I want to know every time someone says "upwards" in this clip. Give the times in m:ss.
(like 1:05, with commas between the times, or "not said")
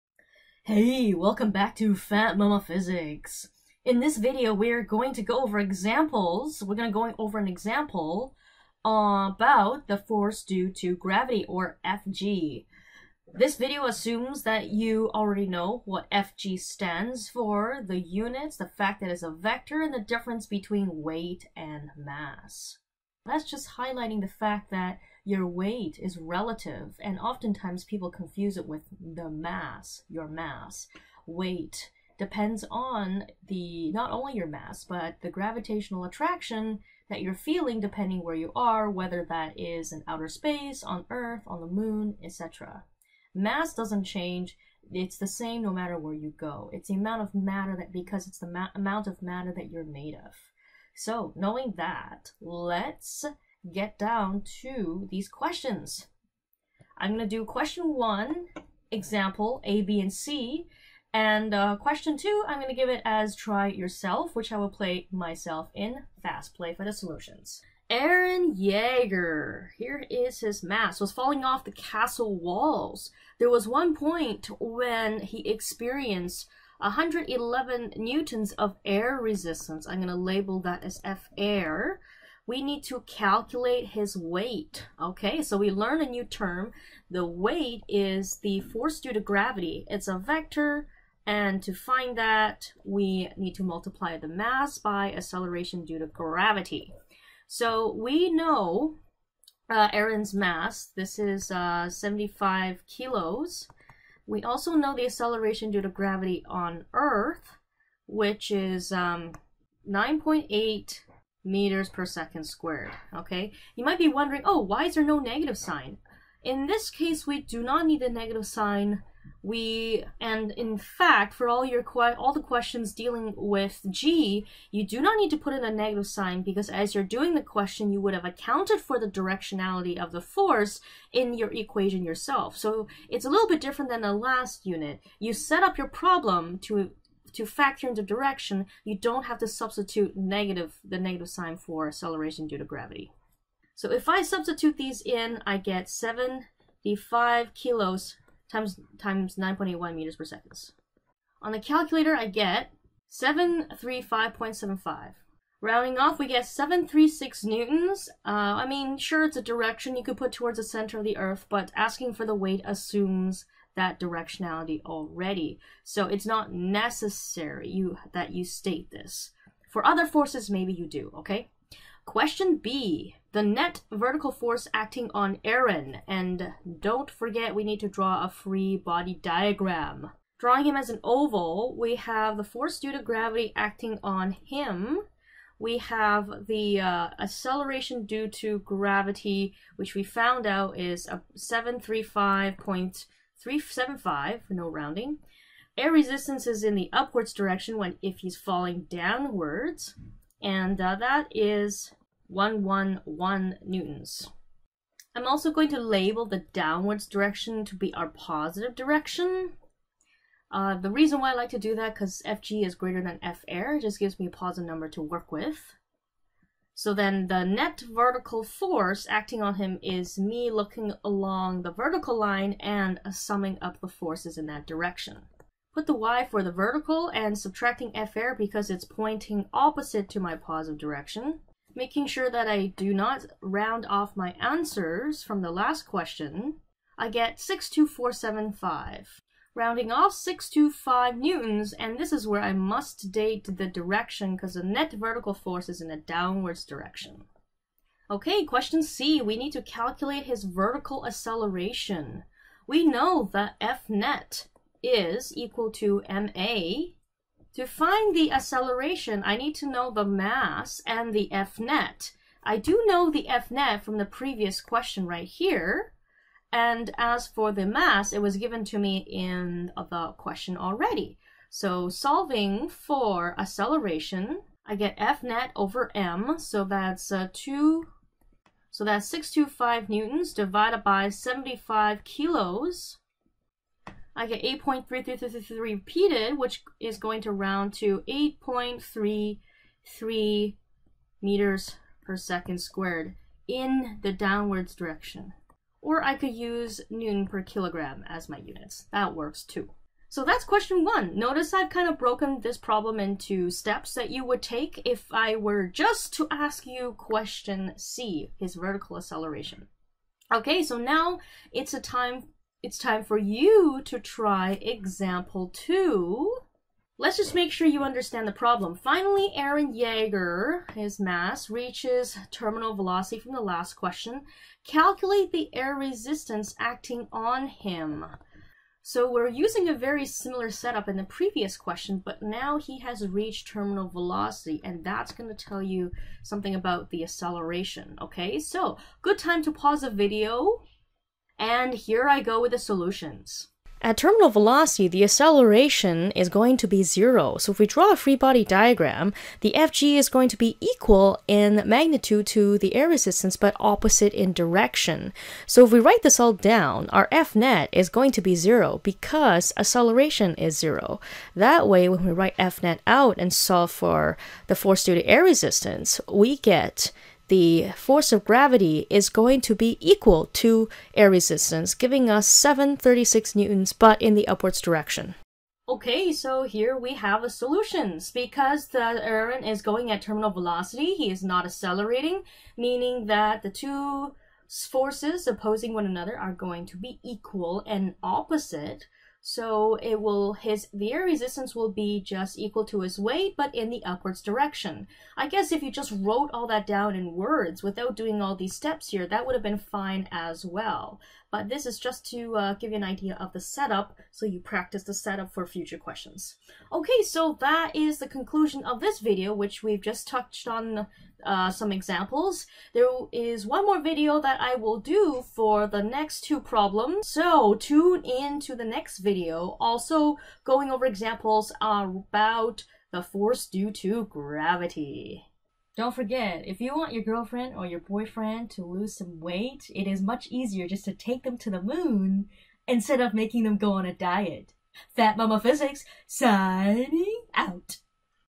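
3:16, 6:14, 6:33.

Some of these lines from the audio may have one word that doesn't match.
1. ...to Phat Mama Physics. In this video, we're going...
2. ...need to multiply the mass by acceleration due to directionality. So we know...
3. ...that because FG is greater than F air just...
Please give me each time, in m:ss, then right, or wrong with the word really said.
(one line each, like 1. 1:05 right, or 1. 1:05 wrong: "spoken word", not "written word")
1. 0:01 right
2. 1:33 wrong: "gravity", not "directionality"
3. 3:31 right.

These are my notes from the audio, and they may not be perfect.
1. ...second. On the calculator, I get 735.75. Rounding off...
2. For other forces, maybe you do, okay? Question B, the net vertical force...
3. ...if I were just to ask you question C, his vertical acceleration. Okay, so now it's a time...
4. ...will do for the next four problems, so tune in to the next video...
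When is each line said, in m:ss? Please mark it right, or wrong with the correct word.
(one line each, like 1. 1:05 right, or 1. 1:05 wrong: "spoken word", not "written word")
1. 2:30 right
2. 2:49 right
3. 5:04 right
4. 6:54 wrong: "two", not "four".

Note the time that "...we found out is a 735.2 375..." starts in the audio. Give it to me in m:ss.
3:09.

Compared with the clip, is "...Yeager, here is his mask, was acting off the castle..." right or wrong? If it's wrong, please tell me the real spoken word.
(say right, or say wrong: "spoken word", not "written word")
wrong: "falling", not "acting".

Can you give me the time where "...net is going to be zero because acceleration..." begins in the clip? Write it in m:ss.
5:57.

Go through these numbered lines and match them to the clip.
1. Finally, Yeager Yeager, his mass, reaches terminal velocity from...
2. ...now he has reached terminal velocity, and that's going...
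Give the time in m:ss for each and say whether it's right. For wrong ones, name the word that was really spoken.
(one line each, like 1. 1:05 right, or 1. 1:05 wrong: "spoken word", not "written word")
1. 5:18 wrong: "Eren", not "Yeager"
2. 5:32 right.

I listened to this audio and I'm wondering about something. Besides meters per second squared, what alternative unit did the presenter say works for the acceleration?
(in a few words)
newton per kilogram.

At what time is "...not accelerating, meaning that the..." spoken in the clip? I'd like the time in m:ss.
6:21.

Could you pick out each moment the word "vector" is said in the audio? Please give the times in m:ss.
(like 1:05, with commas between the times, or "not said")
0:19, 1:30.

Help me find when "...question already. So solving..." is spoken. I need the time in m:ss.
4:30.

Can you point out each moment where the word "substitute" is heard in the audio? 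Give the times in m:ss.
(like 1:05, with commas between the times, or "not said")
2:19, 2:24.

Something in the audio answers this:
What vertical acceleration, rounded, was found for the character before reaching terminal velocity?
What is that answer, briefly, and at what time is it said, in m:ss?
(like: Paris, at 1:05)
8.33 meters per second squared, at 4:48.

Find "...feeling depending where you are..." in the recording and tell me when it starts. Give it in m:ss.
0:37.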